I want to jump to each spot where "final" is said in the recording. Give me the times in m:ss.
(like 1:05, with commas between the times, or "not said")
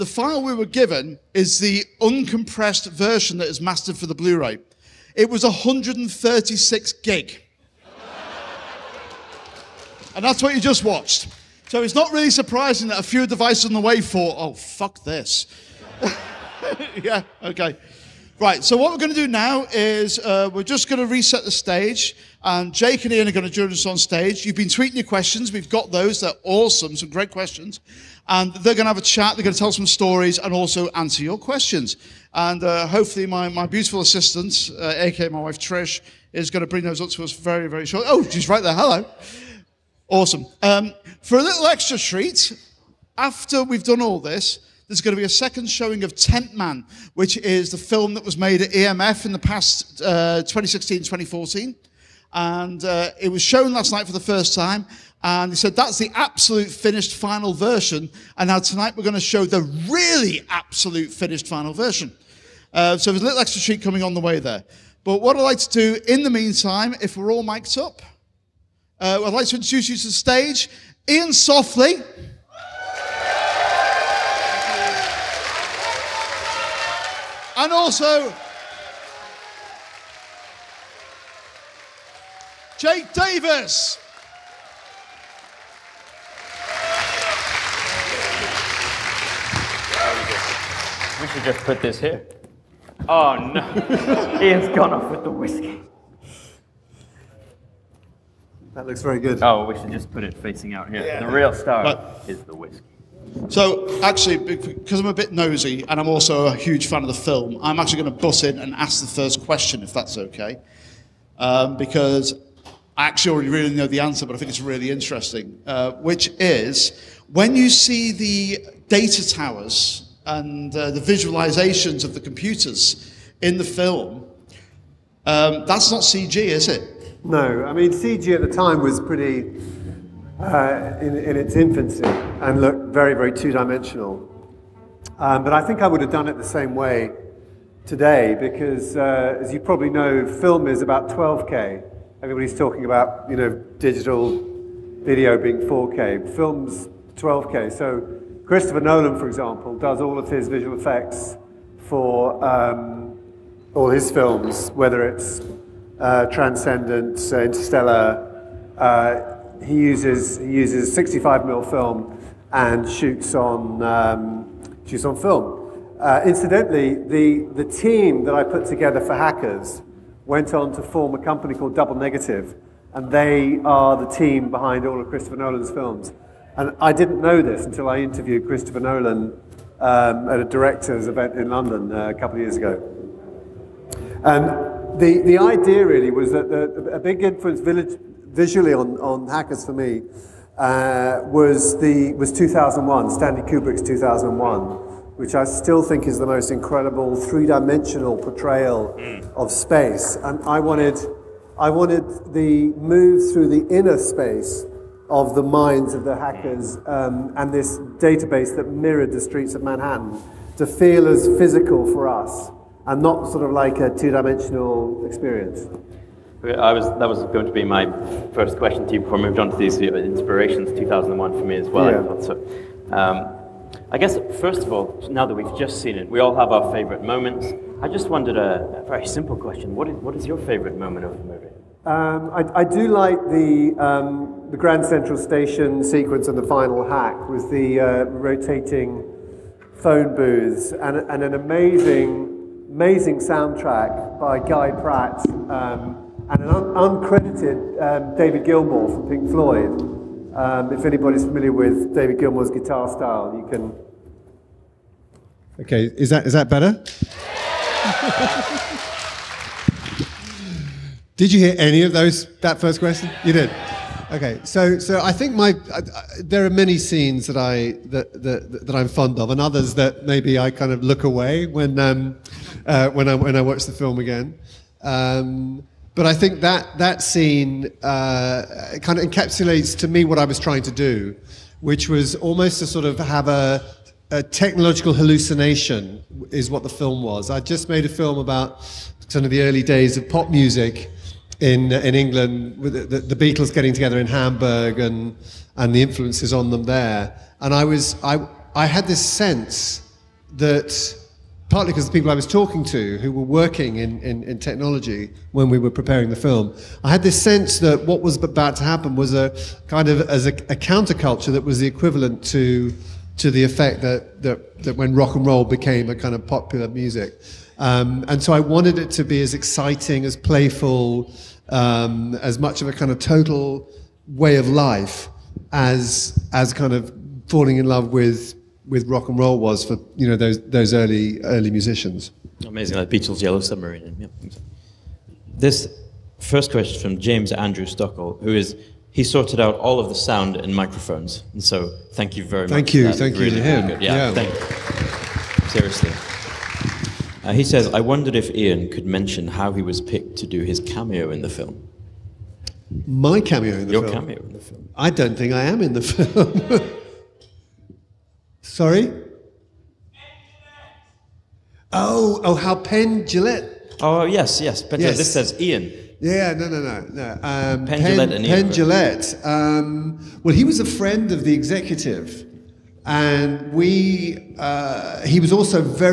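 0:57, 1:01, 3:56.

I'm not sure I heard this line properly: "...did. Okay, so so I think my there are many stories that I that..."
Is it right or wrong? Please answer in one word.
wrong.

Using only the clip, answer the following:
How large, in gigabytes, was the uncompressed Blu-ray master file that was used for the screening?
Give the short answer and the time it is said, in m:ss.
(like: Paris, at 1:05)
136 gig, at 0:05.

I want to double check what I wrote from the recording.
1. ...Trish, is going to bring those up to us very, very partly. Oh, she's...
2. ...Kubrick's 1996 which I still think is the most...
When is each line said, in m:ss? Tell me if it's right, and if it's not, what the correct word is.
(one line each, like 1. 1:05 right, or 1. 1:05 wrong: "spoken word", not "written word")
1. 0:35 wrong: "shortly", not "partly"
2. 3:13 wrong: "2001", not "1996".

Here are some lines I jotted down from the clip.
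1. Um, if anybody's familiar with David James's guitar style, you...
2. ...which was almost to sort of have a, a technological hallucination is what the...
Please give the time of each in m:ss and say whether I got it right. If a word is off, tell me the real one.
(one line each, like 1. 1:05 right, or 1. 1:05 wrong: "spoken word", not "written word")
1. 4:10 wrong: "Gilmour", not "James"
2. 4:41 right.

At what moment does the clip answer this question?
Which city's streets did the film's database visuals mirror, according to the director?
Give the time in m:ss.
3:29.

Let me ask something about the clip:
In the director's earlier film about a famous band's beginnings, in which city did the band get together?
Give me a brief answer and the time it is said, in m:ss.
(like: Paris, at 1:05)
Hamburg, at 4:54.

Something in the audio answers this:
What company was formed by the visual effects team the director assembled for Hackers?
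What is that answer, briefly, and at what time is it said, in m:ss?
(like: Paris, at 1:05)
Double Negative, at 2:51.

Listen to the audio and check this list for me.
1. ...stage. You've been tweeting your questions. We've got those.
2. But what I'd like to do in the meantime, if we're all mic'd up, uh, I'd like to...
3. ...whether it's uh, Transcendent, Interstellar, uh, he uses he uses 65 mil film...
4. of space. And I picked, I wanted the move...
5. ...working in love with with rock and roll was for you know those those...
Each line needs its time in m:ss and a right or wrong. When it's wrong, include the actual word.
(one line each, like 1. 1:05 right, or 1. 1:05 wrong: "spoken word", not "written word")
1. 0:23 right
2. 1:05 right
3. 2:34 right
4. 3:19 wrong: "wanted", not "picked"
5. 5:27 wrong: "falling", not "working".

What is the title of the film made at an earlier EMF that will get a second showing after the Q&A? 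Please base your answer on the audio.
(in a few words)
Tent Man.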